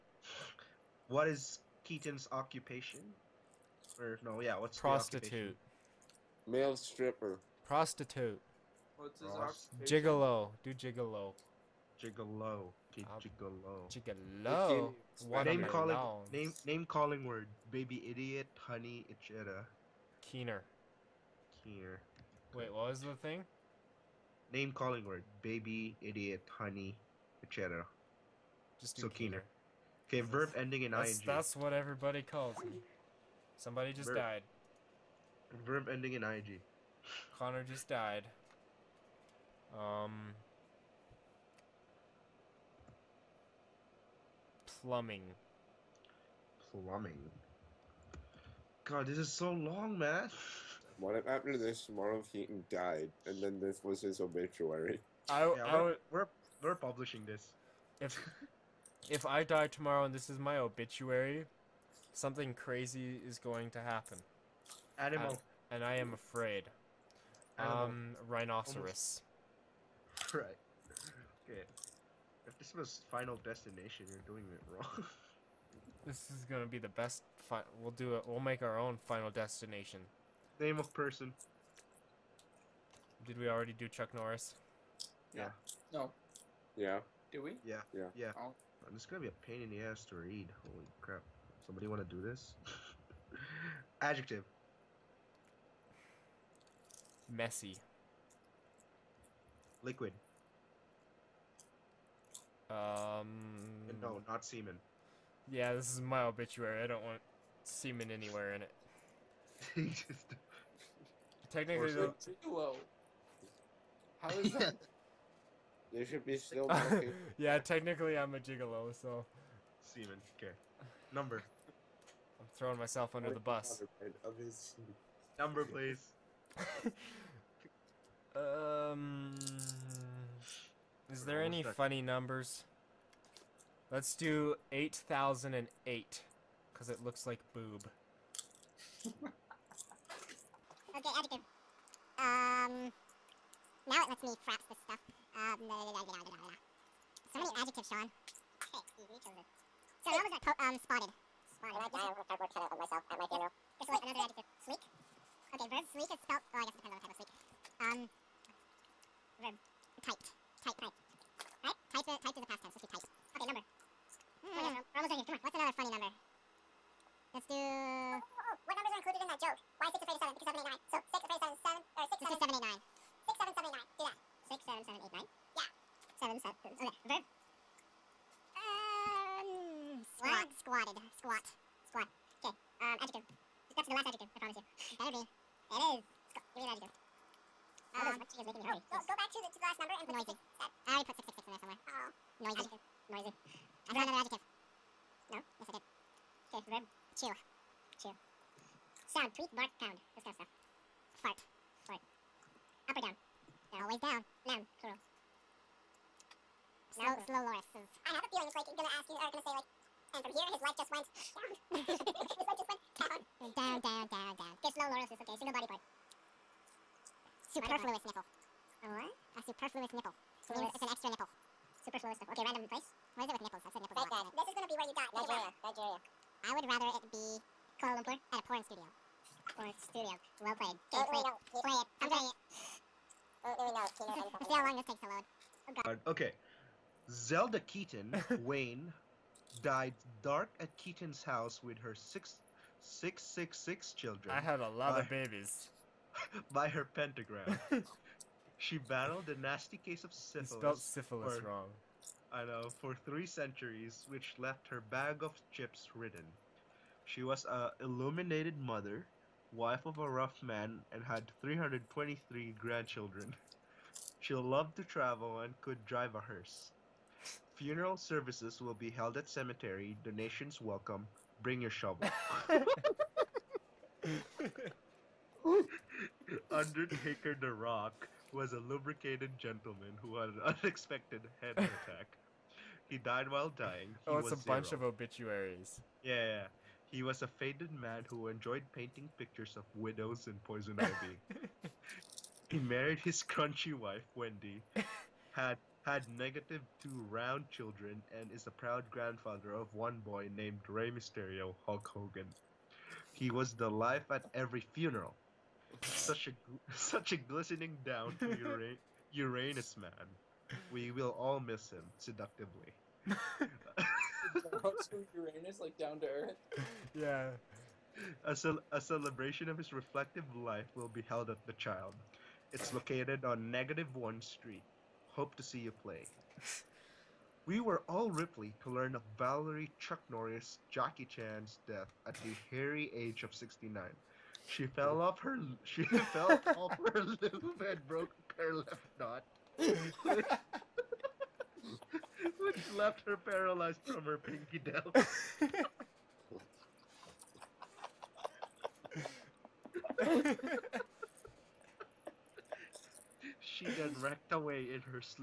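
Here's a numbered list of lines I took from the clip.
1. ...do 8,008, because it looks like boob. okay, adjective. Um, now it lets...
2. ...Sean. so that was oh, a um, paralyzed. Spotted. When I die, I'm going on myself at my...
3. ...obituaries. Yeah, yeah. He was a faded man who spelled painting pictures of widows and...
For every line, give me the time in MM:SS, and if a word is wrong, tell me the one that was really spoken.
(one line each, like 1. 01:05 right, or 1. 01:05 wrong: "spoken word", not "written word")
1. 02:14 right
2. 02:27 wrong: "spotted", not "paralyzed"
3. 04:44 wrong: "enjoyed", not "spelled".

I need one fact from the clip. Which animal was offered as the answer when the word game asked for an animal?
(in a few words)
Rhinoceros.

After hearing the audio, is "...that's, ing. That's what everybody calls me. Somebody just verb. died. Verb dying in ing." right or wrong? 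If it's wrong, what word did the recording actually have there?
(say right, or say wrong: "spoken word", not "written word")
wrong: "ending", not "dying".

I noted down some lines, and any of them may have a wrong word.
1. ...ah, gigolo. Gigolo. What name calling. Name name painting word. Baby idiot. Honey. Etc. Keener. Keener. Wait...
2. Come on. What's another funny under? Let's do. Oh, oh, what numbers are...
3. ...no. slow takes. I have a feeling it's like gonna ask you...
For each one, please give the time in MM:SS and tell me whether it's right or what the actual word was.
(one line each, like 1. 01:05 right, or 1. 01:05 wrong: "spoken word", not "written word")
1. 00:13 wrong: "calling", not "painting"
2. 02:45 wrong: "number", not "under"
3. 03:27 wrong: "lorises", not "takes".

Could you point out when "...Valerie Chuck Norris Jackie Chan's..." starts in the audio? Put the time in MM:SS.
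05:29.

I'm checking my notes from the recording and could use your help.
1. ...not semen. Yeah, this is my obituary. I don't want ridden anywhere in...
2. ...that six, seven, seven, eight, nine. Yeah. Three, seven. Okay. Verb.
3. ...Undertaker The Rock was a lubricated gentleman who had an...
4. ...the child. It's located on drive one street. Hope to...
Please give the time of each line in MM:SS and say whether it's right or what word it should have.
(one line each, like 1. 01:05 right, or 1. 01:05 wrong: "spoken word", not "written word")
1. 01:44 wrong: "semen", not "ridden"
2. 02:54 wrong: "Seven", not "Three"
3. 04:36 right
4. 05:21 wrong: "negative", not "drive".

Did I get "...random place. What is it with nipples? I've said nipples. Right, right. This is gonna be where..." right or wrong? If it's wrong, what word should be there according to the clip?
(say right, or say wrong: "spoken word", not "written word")
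right.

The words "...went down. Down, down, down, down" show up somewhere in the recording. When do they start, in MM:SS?
03:32.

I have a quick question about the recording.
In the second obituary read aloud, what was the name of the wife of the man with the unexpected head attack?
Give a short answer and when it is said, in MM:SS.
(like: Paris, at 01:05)
Wendy, at 04:54.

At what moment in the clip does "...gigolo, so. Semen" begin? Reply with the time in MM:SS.
01:58.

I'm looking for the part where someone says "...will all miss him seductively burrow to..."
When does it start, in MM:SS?
05:10.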